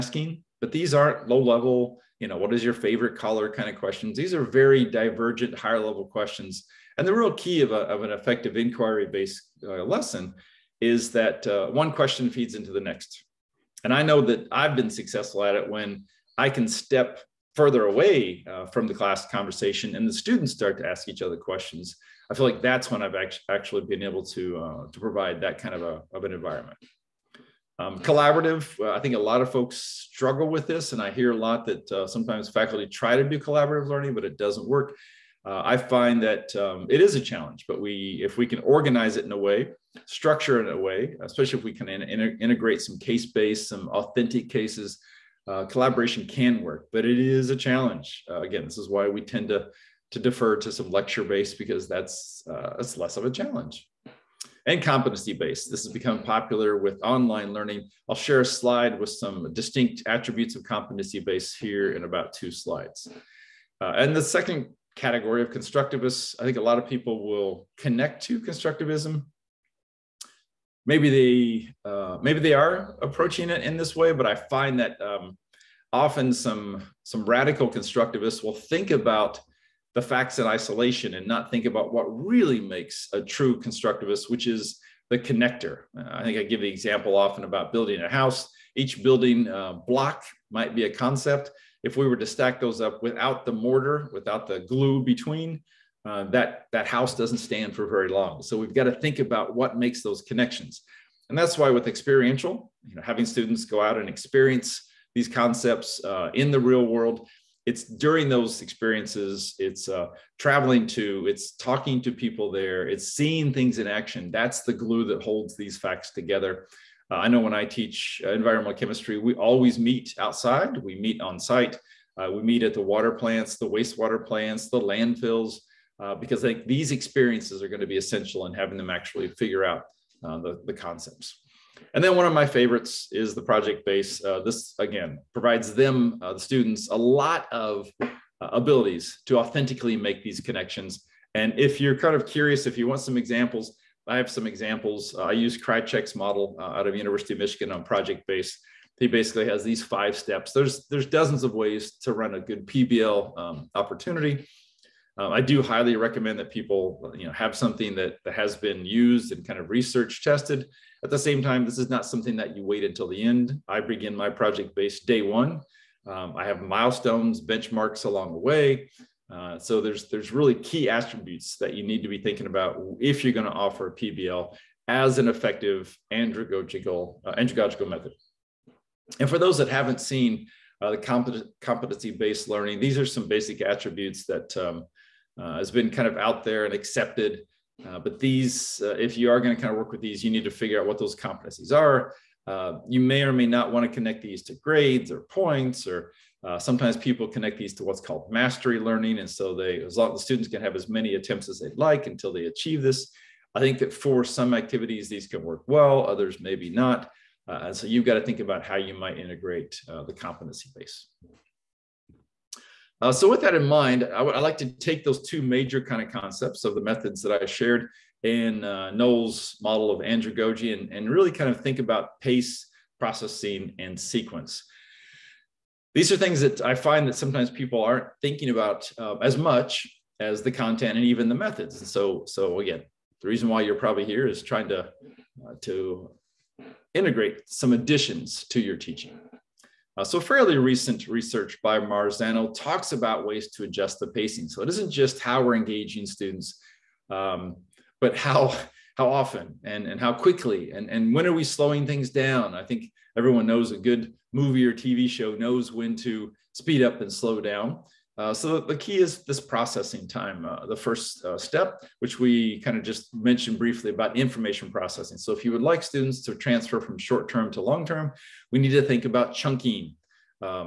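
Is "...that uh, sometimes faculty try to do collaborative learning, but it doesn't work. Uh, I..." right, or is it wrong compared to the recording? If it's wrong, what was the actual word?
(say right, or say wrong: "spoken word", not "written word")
right.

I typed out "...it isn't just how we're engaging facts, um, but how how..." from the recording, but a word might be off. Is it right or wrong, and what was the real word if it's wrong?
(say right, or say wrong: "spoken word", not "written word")
wrong: "students", not "facts".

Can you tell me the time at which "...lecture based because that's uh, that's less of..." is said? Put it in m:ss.
0:50.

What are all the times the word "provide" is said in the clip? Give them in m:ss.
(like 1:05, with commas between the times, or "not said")
0:25, 2:15.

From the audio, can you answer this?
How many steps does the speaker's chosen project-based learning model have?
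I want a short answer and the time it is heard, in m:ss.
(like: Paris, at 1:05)
5, at 2:29.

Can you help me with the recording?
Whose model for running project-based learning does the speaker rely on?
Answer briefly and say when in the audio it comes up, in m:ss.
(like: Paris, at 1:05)
Krajcik, at 2:25.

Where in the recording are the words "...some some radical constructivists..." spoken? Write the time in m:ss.
1:16.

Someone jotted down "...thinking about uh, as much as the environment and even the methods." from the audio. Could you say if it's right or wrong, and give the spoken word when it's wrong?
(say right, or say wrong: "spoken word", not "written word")
wrong: "content", not "environment".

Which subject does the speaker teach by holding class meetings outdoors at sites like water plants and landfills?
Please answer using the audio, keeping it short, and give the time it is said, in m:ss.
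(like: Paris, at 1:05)
environmental chemistry, at 1:58.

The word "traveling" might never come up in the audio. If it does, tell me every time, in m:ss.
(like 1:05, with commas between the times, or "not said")
1:50.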